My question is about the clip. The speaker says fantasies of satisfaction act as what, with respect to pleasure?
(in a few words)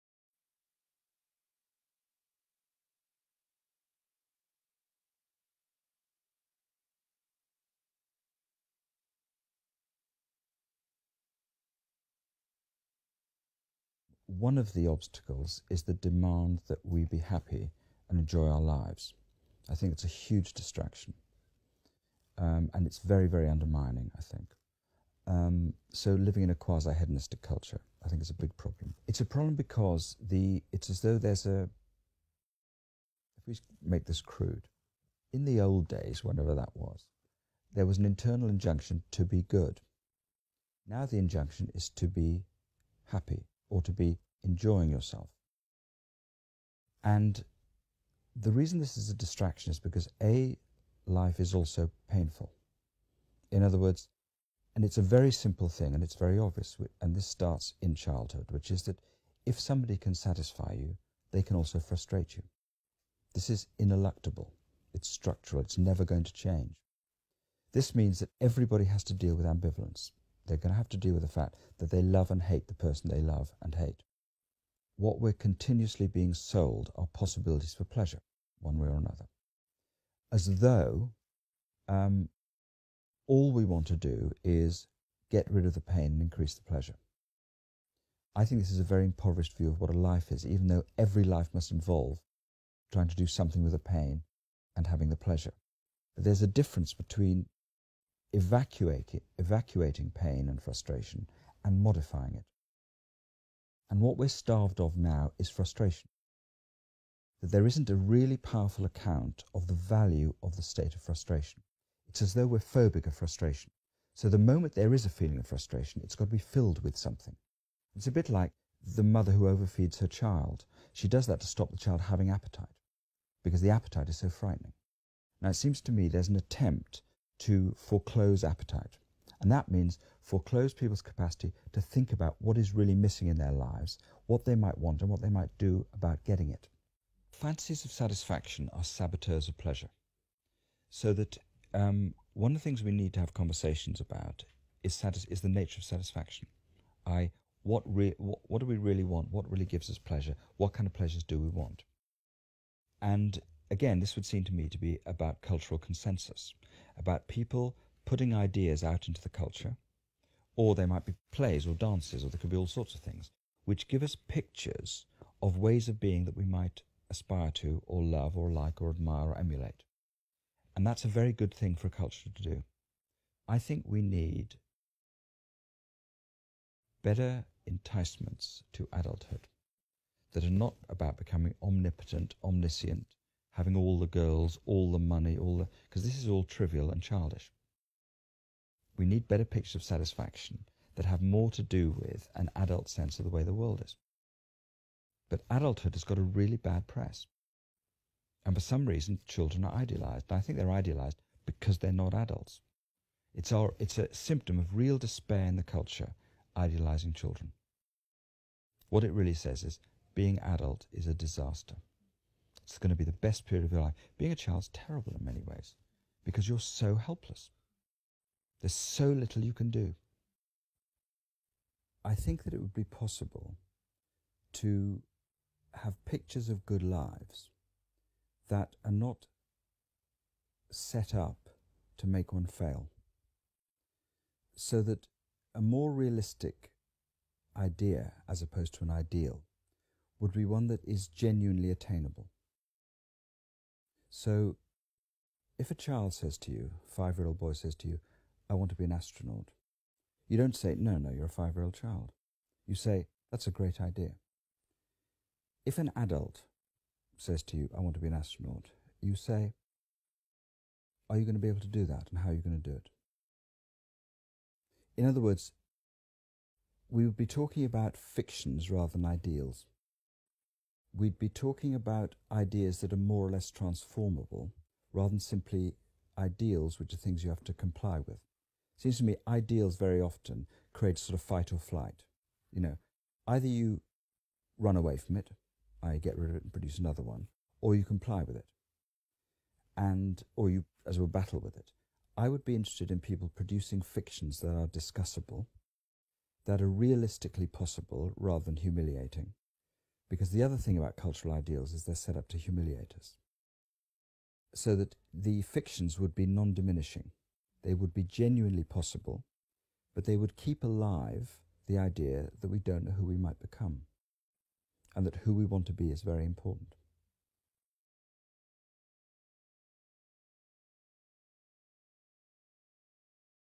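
saboteurs.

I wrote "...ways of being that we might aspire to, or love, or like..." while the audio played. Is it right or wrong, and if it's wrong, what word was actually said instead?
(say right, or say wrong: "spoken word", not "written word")
right.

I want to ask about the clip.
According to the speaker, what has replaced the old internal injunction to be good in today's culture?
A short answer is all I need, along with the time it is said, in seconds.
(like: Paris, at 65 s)
to be happy, at 41 s.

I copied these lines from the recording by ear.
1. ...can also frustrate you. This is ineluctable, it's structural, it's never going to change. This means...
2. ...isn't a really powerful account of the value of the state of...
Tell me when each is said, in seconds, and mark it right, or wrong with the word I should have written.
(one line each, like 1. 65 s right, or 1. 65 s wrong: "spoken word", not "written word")
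1. 61 s right
2. 107 s right.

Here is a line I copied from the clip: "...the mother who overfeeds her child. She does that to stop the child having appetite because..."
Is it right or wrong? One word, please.
right.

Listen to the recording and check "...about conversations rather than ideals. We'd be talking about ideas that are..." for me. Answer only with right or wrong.
wrong.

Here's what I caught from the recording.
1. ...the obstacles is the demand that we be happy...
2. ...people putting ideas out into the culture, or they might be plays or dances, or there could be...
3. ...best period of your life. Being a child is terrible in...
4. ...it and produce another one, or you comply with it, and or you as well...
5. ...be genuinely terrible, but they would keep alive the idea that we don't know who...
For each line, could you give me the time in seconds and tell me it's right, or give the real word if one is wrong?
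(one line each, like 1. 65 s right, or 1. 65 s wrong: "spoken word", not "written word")
1. 14 s right
2. 157 s right
3. 213 s right
4. 286 s right
5. 307 s wrong: "possible", not "terrible".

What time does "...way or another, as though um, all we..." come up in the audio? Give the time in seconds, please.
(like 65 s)
78 s.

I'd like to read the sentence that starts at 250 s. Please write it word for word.
You don't say, no, no, you're a five year old child.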